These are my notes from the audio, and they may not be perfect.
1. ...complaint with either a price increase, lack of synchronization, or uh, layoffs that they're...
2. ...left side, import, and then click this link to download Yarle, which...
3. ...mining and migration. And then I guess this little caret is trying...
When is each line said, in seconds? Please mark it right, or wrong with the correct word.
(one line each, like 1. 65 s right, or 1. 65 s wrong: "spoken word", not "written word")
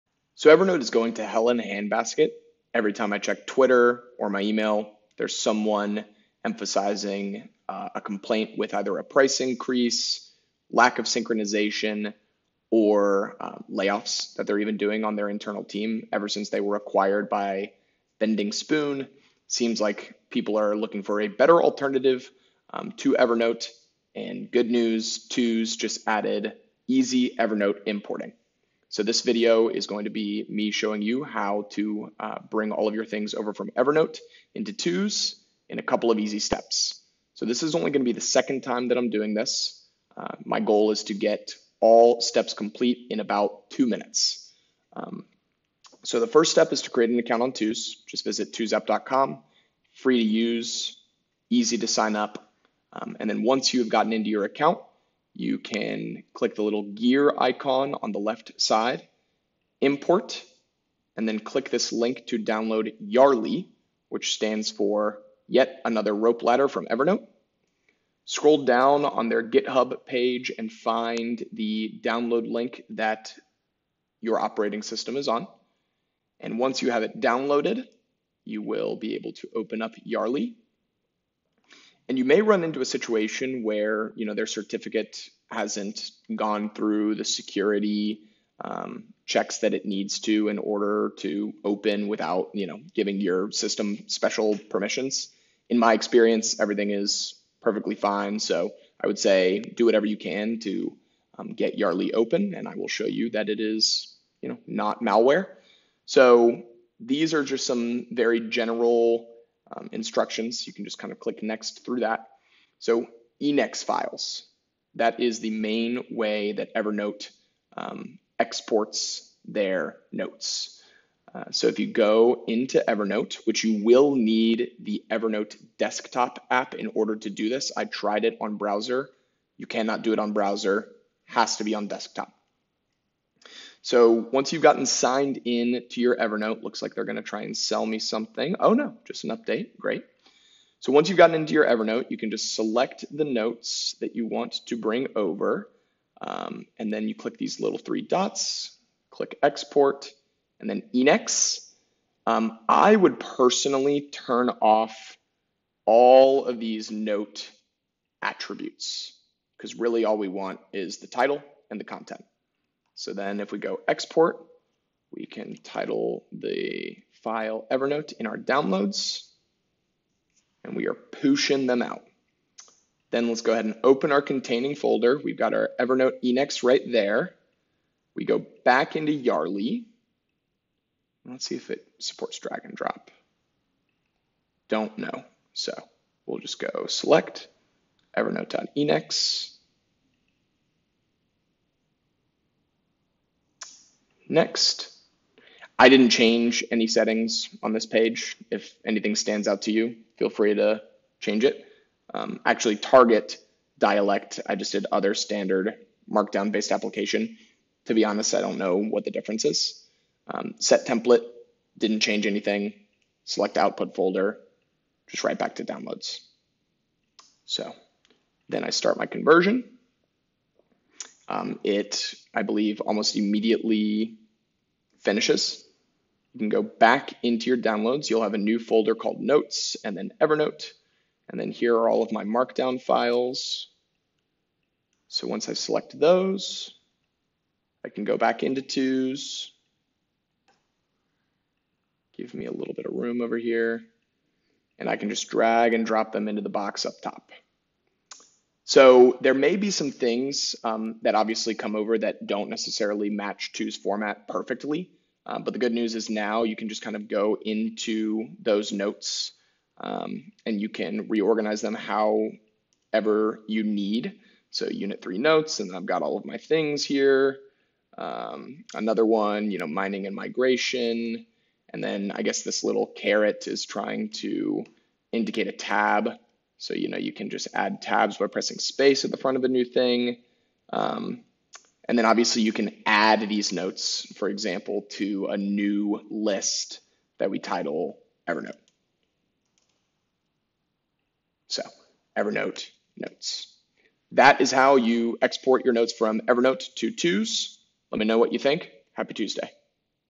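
1. 8 s right
2. 58 s right
3. 269 s right.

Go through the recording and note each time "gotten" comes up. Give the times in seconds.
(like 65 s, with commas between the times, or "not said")
53 s, 134 s, 141 s.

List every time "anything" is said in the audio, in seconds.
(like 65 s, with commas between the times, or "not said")
198 s, 212 s.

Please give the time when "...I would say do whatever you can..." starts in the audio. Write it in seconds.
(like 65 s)
98 s.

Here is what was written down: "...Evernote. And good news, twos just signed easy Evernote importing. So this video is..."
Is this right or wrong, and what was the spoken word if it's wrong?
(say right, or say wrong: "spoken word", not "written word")
wrong: "added", not "signed".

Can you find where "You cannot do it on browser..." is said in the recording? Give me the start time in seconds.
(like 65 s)
129 s.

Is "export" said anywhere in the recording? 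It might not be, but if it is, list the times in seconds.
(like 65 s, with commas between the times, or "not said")
118 s, 149 s, 163 s, 295 s.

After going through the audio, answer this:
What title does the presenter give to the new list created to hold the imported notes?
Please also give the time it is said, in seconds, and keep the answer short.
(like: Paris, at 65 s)
Evernote notes, at 292 s.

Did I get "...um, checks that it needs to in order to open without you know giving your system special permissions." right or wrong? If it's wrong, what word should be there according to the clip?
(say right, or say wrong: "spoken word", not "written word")
right.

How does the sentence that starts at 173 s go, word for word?
Then let's go ahead and open our containing folder.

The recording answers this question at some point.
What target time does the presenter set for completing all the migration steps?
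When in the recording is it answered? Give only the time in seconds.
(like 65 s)
43 s.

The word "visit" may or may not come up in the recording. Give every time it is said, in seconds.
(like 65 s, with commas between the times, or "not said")
48 s.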